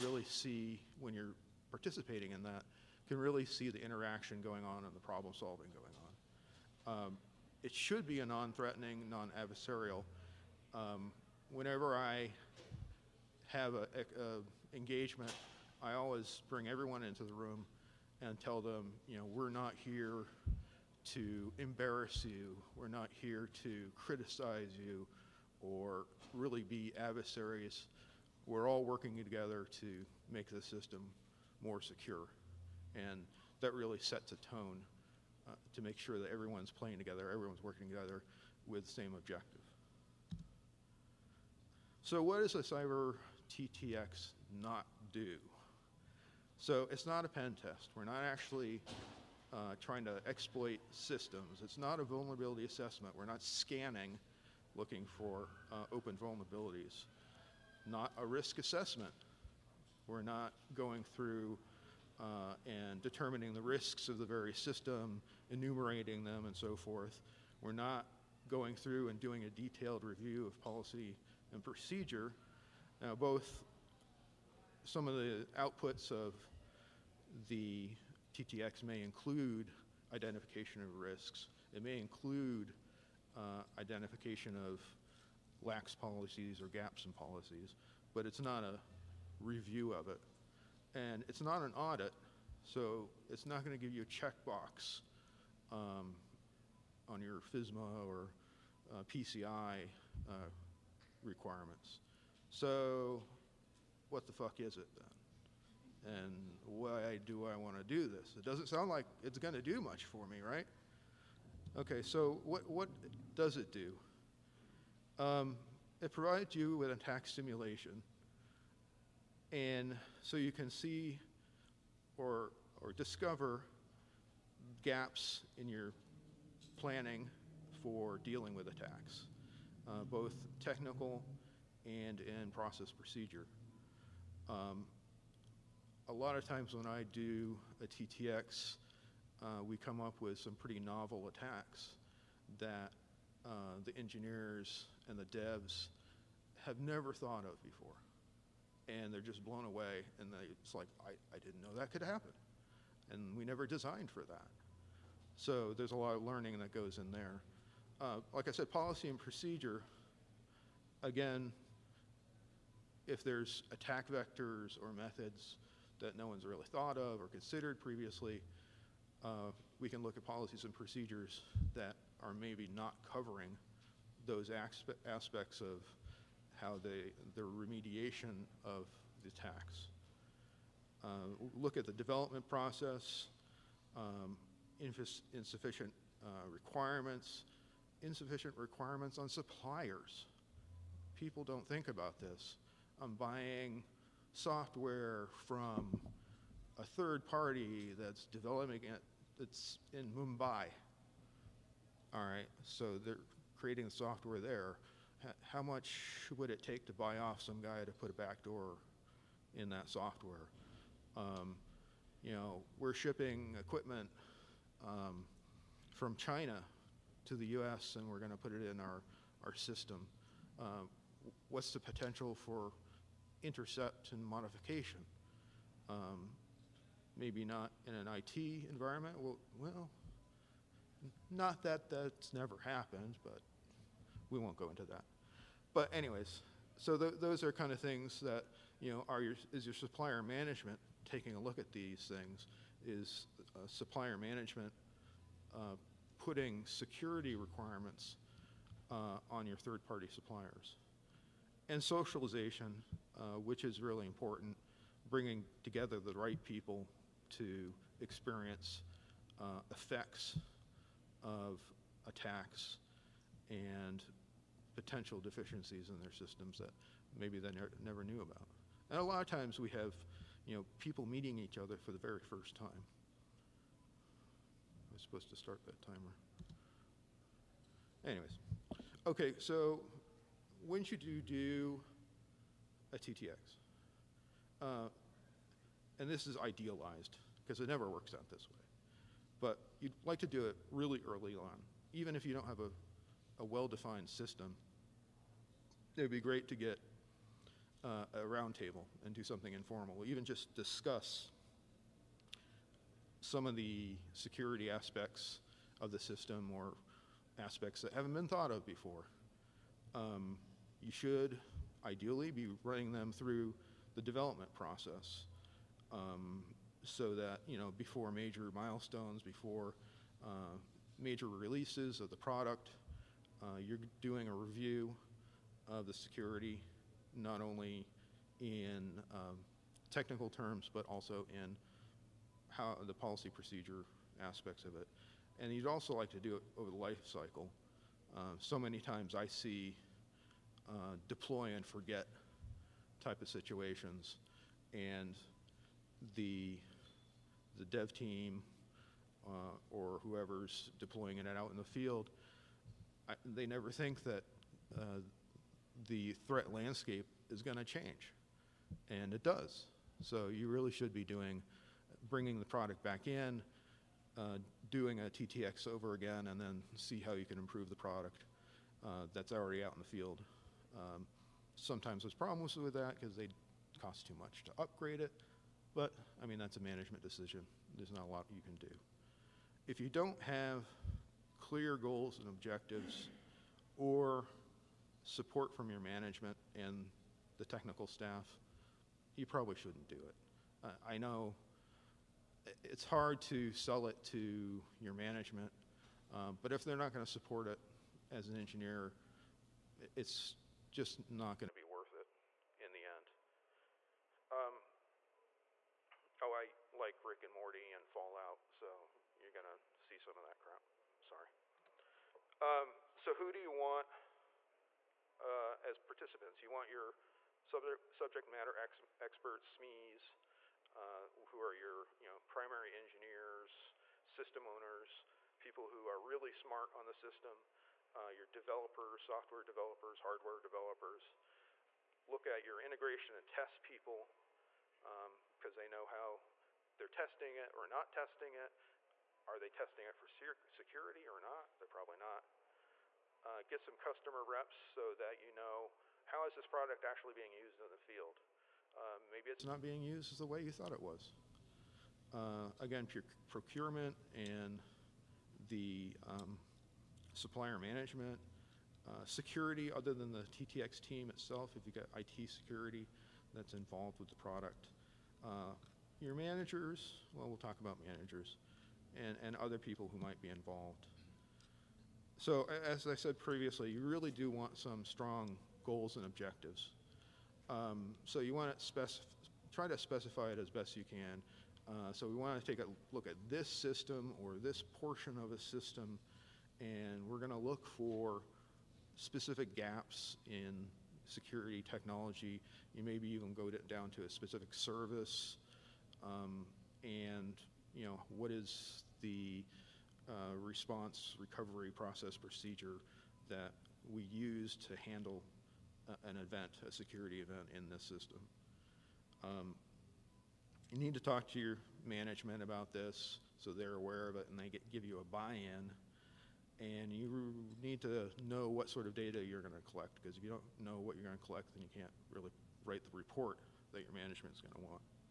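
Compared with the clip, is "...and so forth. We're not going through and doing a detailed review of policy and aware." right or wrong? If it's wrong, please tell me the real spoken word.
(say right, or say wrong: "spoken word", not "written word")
wrong: "procedure", not "aware".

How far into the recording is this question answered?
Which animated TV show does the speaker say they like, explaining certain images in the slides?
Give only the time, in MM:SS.
06:47.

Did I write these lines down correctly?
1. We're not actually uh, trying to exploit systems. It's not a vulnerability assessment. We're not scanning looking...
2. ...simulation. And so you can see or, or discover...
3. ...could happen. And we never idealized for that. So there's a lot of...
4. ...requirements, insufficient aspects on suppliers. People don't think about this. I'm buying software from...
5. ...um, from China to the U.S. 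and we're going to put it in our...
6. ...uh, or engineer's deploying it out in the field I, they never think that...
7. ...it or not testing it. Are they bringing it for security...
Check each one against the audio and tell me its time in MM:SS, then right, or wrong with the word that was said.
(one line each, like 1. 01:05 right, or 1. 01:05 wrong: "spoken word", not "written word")
1. 00:47 right
2. 01:57 right
3. 02:31 wrong: "designed", not "idealized"
4. 03:06 wrong: "requirements", not "aspects"
5. 03:34 right
6. 05:49 wrong: "whoever", not "engineer"
7. 07:17 wrong: "testing", not "bringing".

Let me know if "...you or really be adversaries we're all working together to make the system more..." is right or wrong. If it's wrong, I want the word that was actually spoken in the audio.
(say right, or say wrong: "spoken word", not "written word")
right.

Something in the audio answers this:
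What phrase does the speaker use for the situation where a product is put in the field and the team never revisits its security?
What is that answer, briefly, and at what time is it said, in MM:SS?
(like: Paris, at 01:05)
deploy and forget, at 05:41.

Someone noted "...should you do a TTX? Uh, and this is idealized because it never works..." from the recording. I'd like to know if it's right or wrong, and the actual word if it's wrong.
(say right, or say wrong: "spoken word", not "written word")
right.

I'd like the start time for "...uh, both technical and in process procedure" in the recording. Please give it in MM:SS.
02:09.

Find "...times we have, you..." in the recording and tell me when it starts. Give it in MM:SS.
04:29.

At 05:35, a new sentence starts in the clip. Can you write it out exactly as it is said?
And you'd also like to do it over the life cycle.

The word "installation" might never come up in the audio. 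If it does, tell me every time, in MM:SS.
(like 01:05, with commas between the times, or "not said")
not said.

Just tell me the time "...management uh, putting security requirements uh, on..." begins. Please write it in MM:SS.
04:04.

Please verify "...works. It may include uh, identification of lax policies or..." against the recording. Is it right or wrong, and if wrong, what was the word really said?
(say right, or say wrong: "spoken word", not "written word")
wrong: "risks", not "works".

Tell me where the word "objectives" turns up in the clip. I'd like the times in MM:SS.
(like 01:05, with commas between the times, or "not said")
00:39, 06:22, 07:56.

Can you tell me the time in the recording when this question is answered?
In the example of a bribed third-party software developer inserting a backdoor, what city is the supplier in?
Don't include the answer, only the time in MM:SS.
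03:20.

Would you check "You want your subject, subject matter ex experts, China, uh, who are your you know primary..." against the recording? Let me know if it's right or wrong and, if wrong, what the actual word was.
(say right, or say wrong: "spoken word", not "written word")
wrong: "SMEs", not "China".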